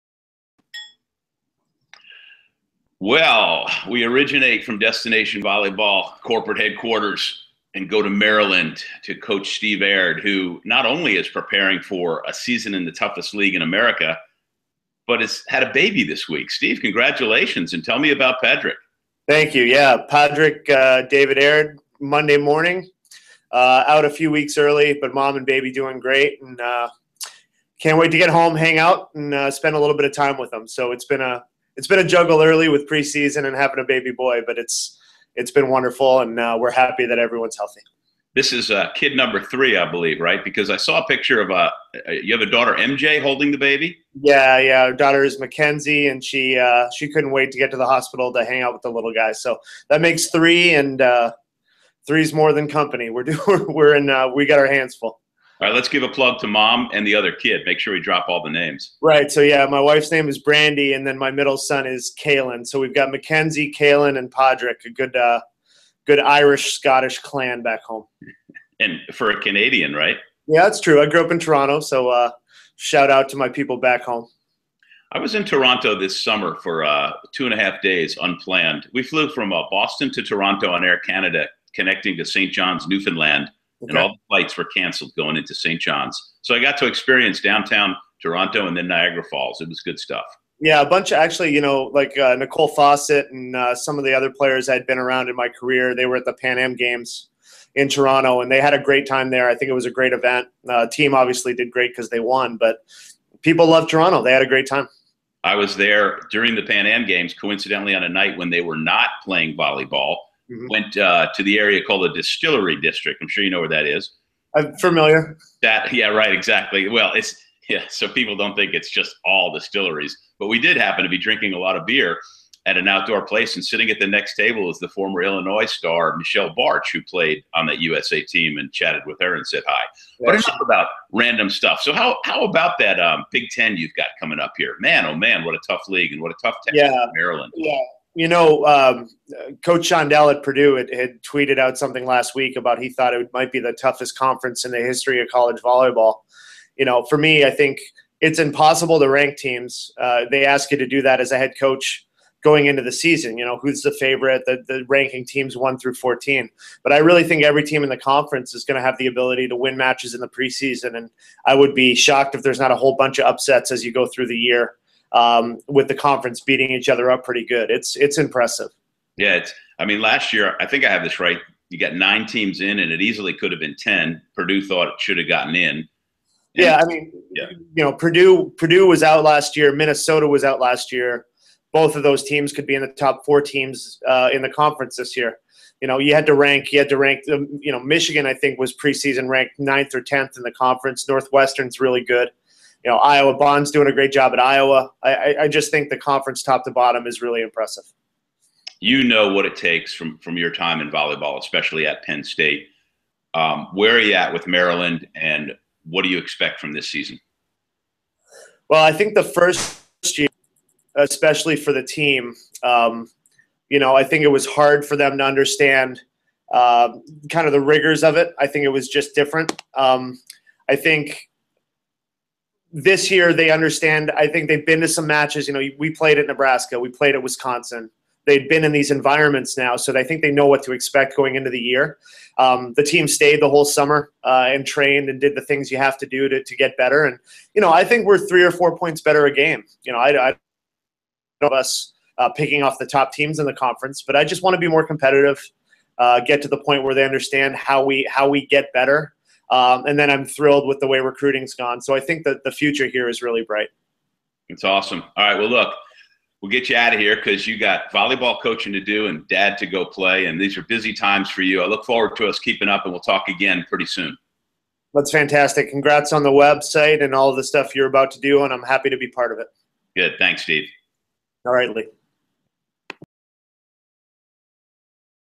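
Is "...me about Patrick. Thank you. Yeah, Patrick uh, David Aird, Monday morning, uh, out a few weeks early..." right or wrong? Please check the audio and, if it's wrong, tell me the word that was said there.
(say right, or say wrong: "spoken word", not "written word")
right.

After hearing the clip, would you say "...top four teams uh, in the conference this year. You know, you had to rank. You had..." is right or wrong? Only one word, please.
right.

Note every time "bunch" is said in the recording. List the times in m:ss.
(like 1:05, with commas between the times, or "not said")
1:30, 2:42.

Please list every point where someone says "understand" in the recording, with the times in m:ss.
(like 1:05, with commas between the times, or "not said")
3:35, 3:43, 4:07.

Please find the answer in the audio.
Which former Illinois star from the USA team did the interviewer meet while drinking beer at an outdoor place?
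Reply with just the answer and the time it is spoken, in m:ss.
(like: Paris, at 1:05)
Michelle Bartsch, at 2:06.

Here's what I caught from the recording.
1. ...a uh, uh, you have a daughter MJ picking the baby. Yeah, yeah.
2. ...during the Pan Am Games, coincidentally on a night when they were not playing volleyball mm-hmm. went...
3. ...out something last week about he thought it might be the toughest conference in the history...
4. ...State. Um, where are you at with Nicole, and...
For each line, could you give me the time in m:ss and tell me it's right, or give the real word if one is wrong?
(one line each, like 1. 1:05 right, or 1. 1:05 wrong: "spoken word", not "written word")
1. 0:41 wrong: "holding", not "picking"
2. 1:46 right
3. 2:21 right
4. 3:22 wrong: "Maryland", not "Nicole".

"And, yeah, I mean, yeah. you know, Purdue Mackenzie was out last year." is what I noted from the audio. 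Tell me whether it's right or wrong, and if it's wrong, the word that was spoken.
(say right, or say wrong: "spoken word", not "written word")
wrong: "Purdue", not "Mackenzie".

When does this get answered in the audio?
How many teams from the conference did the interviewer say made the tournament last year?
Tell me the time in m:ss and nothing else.
2:51.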